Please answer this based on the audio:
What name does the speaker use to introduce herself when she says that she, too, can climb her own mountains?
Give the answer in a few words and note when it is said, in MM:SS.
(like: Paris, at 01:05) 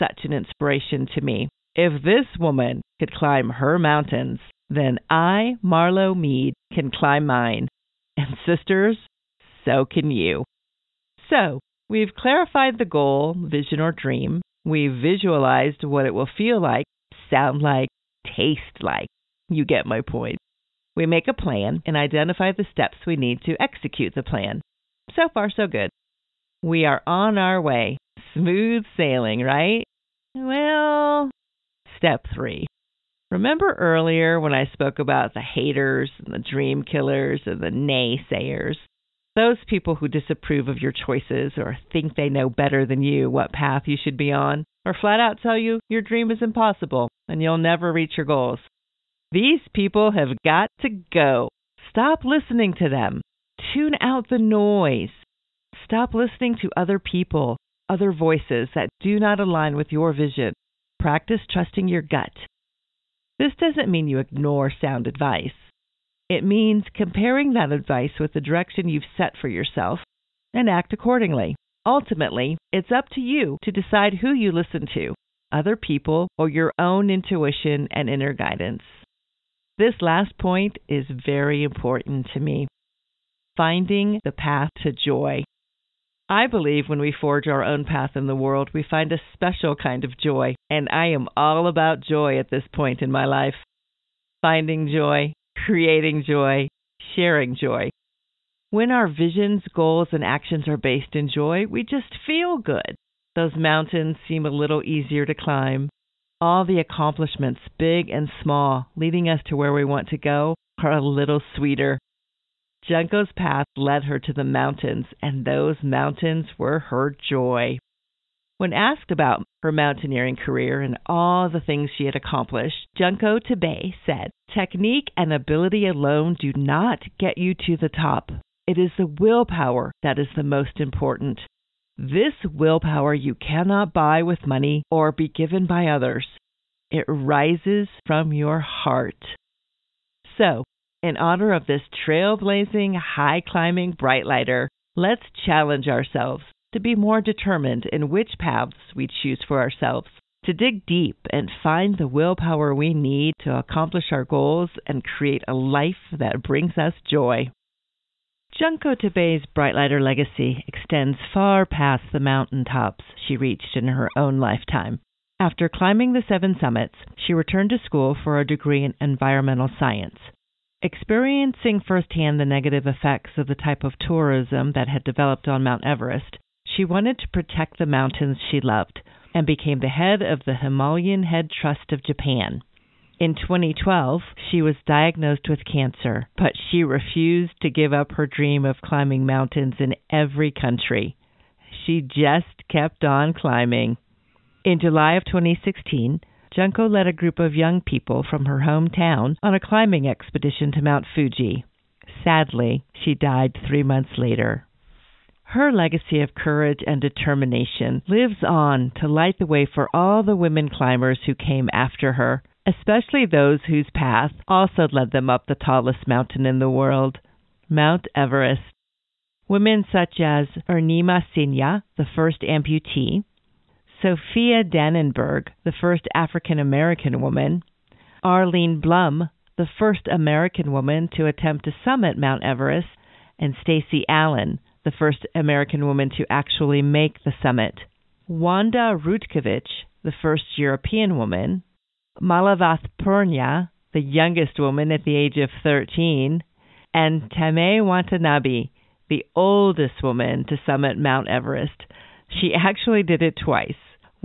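Marlo Mead, at 00:05.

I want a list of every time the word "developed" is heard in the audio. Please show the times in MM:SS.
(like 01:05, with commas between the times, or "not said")
02:55.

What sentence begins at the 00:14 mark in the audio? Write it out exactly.
We've visualized what it will feel like, sound like, taste like.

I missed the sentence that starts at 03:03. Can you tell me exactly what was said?
In 2012, she was diagnosed with cancer, but she refused to give up her dream of climbing mountains in every country.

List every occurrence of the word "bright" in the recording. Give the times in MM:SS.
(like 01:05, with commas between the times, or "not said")
02:23, 02:39.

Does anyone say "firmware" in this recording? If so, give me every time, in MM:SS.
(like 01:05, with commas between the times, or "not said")
not said.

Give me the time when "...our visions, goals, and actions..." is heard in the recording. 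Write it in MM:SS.
01:38.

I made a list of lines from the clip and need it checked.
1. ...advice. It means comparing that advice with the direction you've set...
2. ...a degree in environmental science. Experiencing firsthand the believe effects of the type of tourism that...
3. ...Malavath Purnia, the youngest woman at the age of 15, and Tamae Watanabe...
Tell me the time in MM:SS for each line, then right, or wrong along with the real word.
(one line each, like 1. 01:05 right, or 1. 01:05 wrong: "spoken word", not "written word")
1. 01:05 right
2. 02:48 wrong: "negative", not "believe"
3. 04:02 wrong: "13", not "15".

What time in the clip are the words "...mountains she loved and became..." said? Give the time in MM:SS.
02:57.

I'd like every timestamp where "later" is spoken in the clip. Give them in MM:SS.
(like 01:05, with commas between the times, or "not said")
03:24.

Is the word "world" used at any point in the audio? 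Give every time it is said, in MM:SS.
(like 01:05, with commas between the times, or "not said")
01:28, 03:36.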